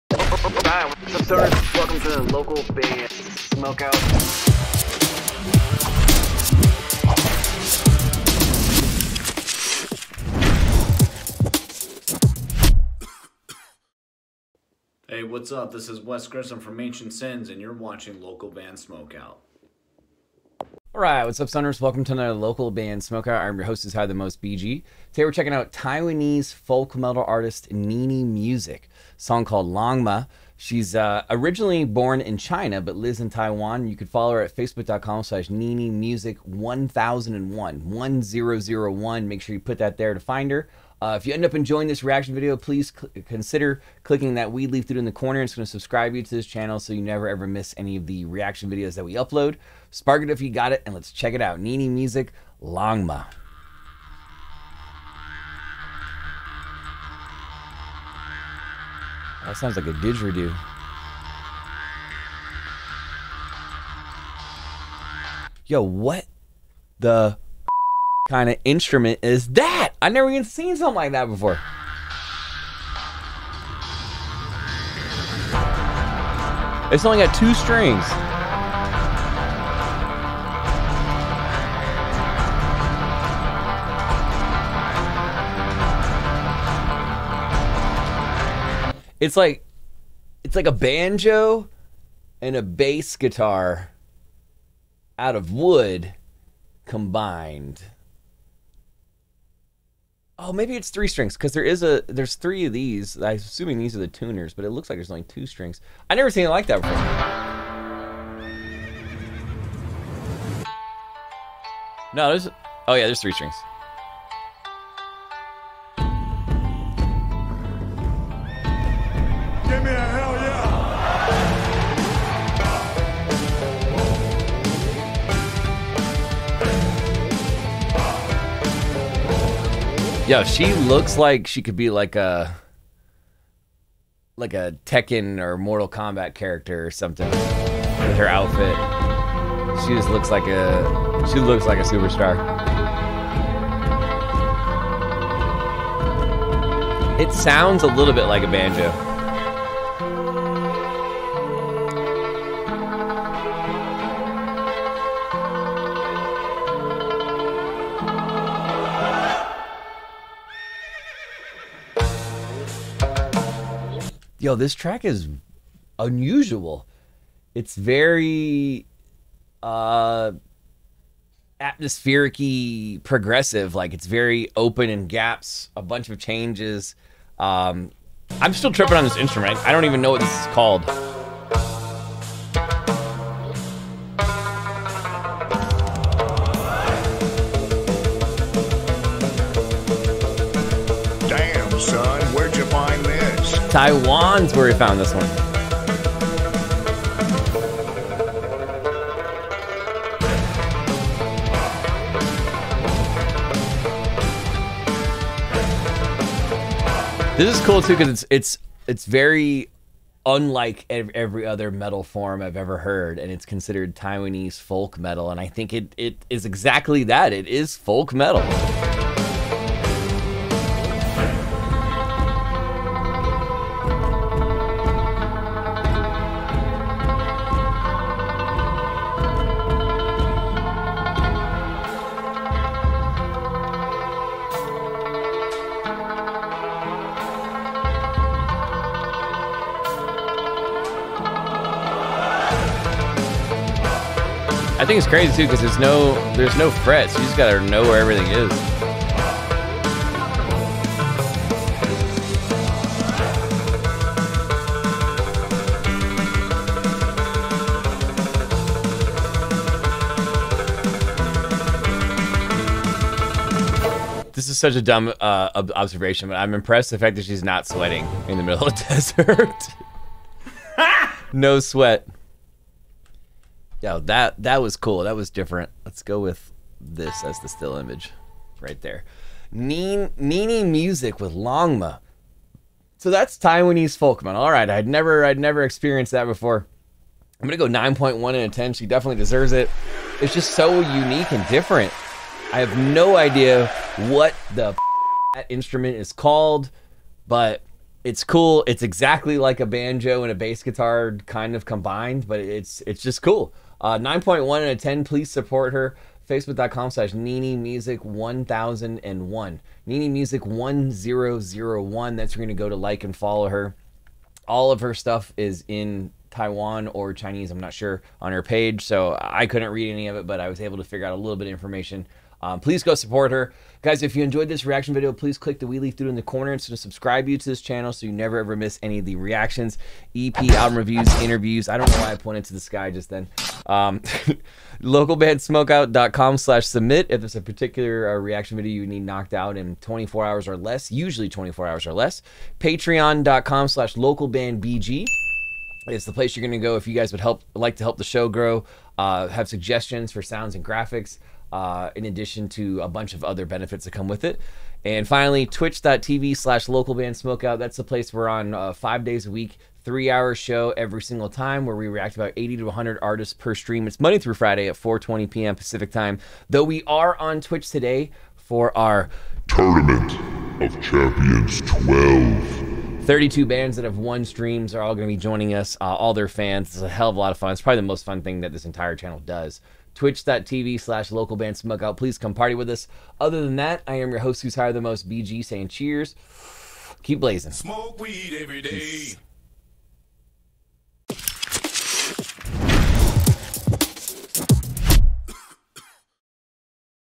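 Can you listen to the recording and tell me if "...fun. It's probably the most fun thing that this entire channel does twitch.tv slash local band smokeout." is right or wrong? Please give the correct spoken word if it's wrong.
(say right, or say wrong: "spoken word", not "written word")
right.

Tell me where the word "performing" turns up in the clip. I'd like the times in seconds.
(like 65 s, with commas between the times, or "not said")
not said.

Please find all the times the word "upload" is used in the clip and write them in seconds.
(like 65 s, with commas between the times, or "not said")
49 s.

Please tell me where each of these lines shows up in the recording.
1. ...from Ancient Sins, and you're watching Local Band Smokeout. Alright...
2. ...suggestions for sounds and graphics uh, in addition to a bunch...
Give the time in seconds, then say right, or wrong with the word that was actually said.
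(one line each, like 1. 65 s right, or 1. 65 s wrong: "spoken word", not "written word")
1. 16 s right
2. 349 s right.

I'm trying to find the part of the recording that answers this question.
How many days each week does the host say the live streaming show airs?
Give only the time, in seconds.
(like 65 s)
358 s.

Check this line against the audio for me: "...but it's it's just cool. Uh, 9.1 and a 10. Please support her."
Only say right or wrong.
right.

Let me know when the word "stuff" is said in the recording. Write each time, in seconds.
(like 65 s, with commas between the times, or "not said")
314 s.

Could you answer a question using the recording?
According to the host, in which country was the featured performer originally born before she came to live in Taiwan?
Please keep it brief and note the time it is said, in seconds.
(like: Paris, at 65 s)
China, at 32 s.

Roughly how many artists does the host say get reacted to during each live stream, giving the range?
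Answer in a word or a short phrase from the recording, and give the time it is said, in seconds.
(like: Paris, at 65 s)
80 to 100, at 362 s.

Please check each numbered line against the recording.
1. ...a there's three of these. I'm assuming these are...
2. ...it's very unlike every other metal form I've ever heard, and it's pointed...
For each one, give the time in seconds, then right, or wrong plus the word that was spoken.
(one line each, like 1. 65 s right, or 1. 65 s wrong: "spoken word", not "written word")
1. 101 s right
2. 208 s wrong: "considered", not "pointed".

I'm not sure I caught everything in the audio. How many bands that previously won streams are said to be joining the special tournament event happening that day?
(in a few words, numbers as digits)
32.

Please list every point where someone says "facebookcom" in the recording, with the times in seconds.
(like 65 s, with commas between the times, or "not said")
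34 s, 306 s.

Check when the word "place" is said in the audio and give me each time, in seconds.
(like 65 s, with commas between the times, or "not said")
346 s, 357 s.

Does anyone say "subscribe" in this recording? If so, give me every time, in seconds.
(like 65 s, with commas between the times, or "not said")
45 s, 326 s.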